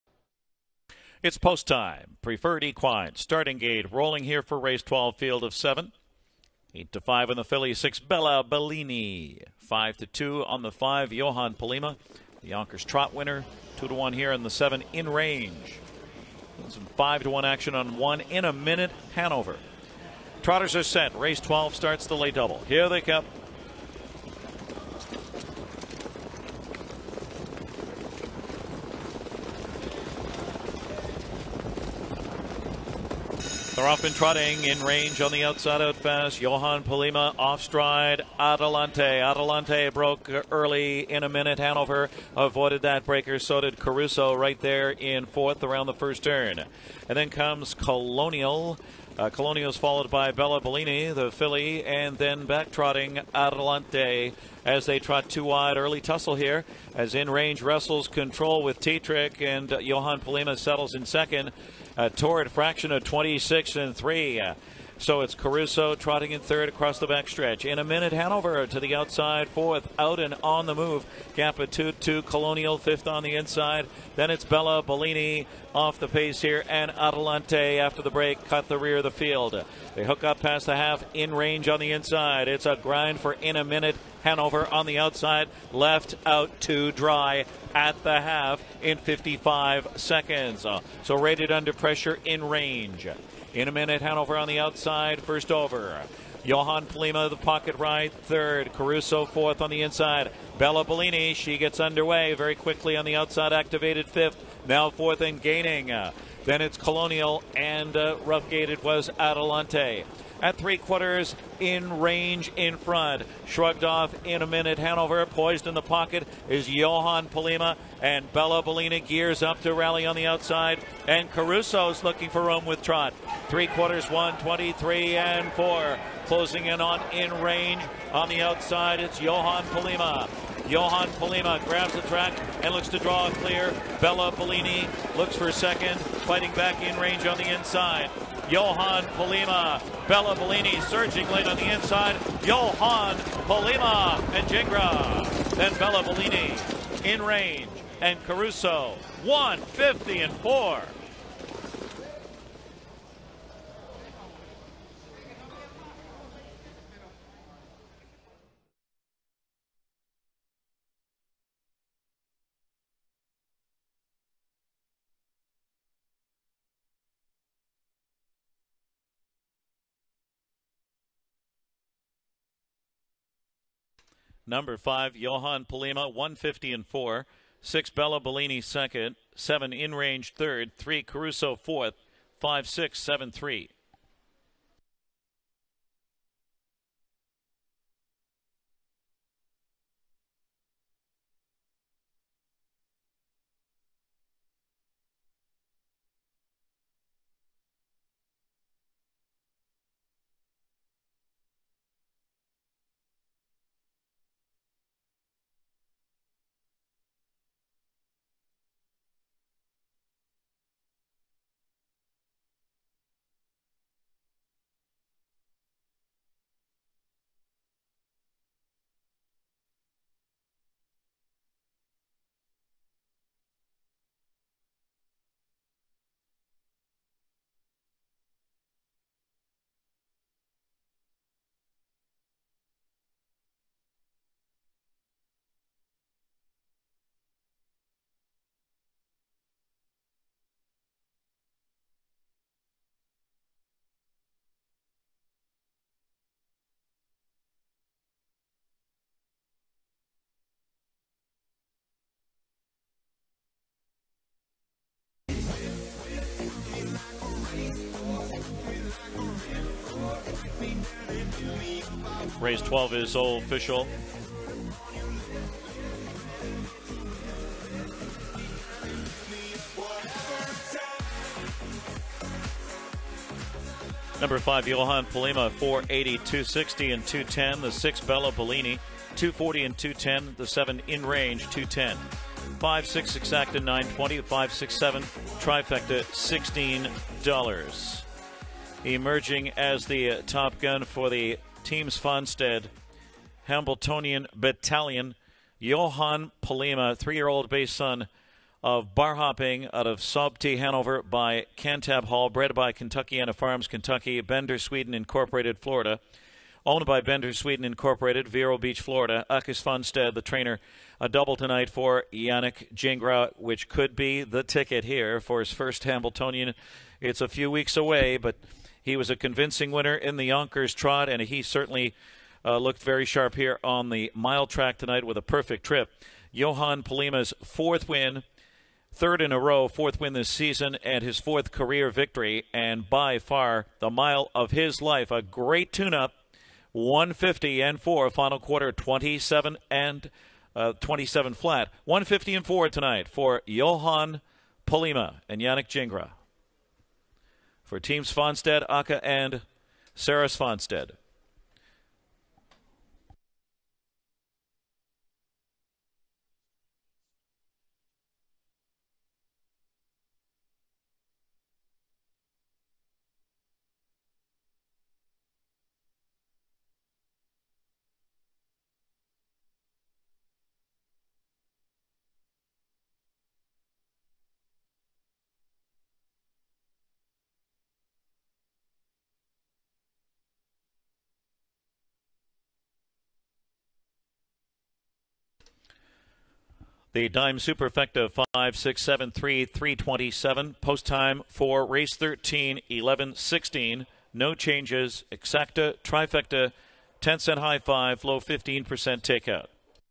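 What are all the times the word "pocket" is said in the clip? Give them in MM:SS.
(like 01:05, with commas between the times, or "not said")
01:37, 01:55.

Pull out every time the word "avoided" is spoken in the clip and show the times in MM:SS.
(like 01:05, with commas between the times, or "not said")
00:42.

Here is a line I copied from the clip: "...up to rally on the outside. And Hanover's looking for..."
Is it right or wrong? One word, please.
wrong.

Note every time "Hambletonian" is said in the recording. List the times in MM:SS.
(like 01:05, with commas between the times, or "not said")
04:53, 05:15.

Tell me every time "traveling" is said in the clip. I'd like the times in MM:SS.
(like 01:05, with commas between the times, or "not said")
not said.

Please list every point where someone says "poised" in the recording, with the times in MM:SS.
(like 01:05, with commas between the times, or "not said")
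01:55.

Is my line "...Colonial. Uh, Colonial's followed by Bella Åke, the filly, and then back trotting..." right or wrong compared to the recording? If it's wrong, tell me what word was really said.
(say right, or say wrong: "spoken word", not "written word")
wrong: "Bellini", not "Åke".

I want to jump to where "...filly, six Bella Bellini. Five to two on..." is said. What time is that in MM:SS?
00:07.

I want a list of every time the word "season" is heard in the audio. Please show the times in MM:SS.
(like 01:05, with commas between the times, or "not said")
05:30.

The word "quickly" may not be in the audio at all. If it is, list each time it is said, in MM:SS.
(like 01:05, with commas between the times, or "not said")
01:42.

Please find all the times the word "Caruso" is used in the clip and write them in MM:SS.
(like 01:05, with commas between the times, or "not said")
00:43, 01:05, 01:38, 02:01, 02:28, 03:01.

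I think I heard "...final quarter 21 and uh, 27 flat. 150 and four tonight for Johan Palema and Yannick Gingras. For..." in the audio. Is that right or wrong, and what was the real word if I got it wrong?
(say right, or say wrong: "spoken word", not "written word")
wrong: "27", not "21".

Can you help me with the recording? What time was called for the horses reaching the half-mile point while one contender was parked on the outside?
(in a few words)
55 seconds.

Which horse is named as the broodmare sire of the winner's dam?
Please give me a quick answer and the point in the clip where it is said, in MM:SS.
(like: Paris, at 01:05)
Cantab Hall, at 05:01.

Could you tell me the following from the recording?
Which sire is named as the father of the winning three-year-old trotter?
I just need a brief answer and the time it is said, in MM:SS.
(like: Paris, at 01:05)
Bar Hopping, at 04:58.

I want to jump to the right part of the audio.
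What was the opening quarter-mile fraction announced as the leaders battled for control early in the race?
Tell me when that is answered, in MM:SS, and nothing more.
01:03.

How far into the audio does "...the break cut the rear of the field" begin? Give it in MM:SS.
01:18.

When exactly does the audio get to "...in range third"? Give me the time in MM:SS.
02:59.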